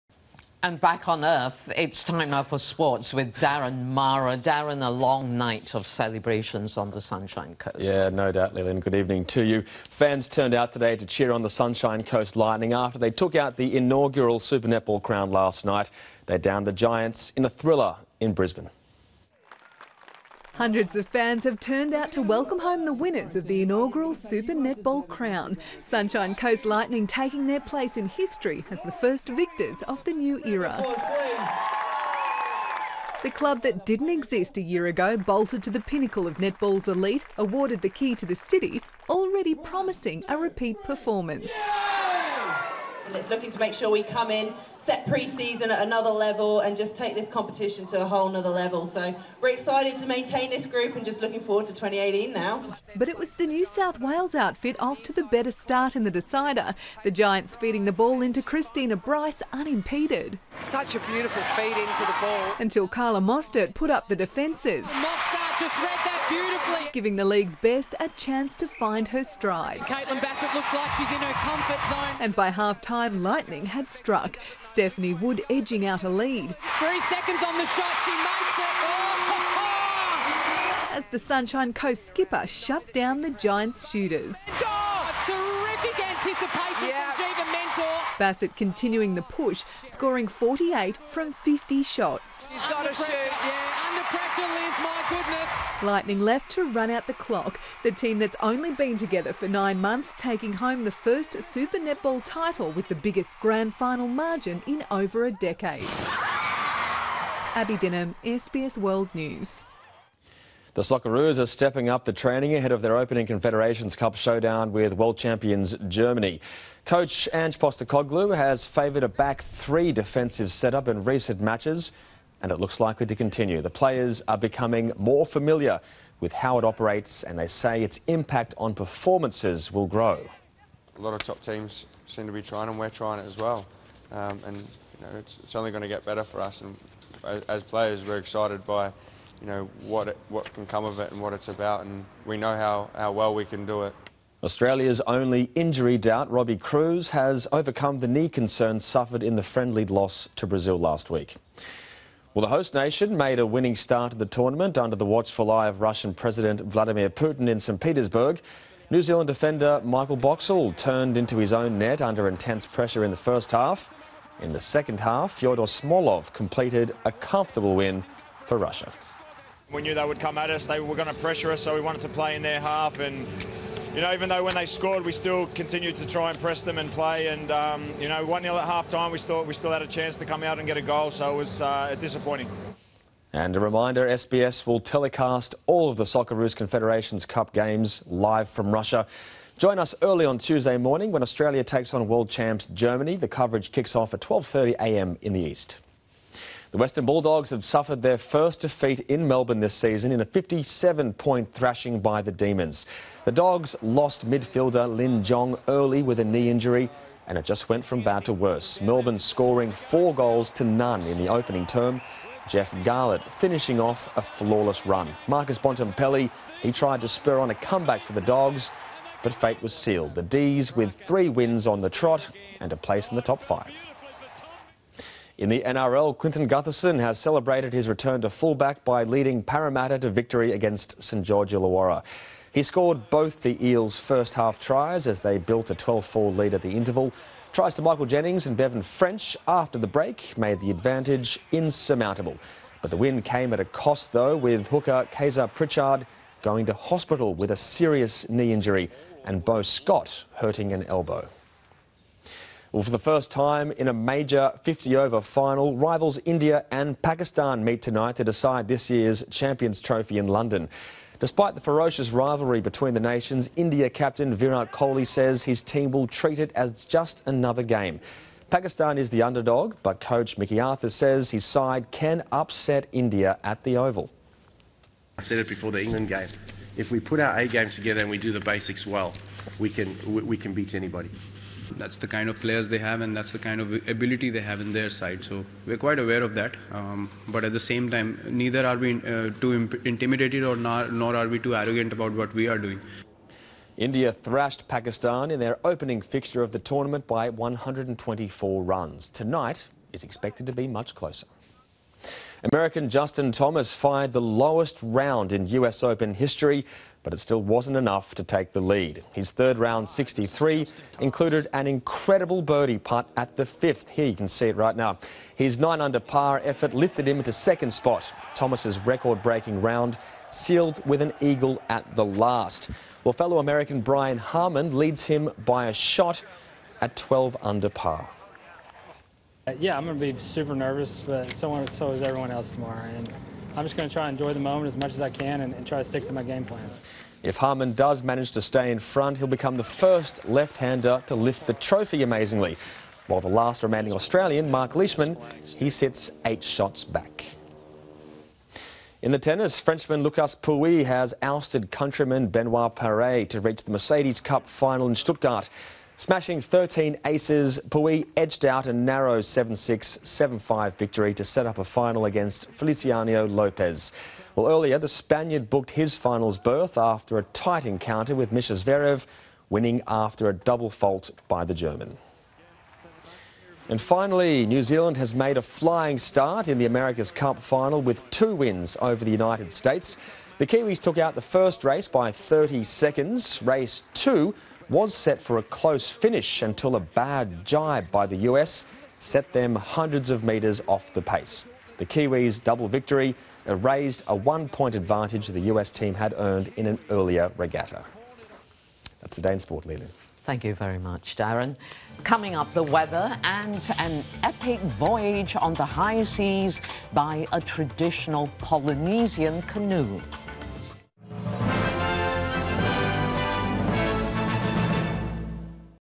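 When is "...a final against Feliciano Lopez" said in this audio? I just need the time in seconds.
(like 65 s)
361 s.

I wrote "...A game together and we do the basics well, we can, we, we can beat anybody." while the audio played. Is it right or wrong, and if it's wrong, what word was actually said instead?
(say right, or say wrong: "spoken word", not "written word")
right.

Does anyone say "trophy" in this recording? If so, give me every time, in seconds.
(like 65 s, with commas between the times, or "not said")
259 s, 341 s.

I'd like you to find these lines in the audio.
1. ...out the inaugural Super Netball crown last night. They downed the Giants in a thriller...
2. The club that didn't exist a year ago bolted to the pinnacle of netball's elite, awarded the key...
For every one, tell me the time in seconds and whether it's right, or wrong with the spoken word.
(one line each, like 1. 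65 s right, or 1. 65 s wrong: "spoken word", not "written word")
1. 13 s right
2. 33 s right.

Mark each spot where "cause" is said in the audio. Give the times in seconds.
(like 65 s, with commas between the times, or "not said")
not said.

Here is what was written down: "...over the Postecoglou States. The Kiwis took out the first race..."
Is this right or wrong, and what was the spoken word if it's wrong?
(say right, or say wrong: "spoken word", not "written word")
wrong: "United", not "Postecoglou".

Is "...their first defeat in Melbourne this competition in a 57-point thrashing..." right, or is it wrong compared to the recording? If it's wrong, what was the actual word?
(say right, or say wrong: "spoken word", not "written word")
wrong: "season", not "competition".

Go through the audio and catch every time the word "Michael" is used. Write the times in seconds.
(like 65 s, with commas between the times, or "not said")
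159 s, 237 s.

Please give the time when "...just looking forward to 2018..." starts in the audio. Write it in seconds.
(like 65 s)
51 s.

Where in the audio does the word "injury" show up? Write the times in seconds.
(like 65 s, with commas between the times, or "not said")
145 s, 206 s, 248 s.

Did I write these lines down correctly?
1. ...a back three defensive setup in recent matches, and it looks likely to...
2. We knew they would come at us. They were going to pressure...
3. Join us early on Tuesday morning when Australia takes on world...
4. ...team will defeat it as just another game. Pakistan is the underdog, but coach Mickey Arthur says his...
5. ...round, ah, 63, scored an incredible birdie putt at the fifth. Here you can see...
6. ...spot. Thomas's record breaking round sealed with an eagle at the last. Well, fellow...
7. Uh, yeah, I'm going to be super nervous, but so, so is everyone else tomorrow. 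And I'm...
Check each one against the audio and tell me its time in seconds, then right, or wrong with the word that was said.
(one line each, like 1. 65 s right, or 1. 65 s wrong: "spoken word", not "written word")
1. 119 s right
2. 169 s right
3. 189 s right
4. 265 s wrong: "treat", not "defeat"
5. 309 s wrong: "included", not "scored"
6. 317 s right
7. 329 s right.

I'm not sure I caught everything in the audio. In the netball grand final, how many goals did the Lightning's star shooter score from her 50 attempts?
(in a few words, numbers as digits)
48.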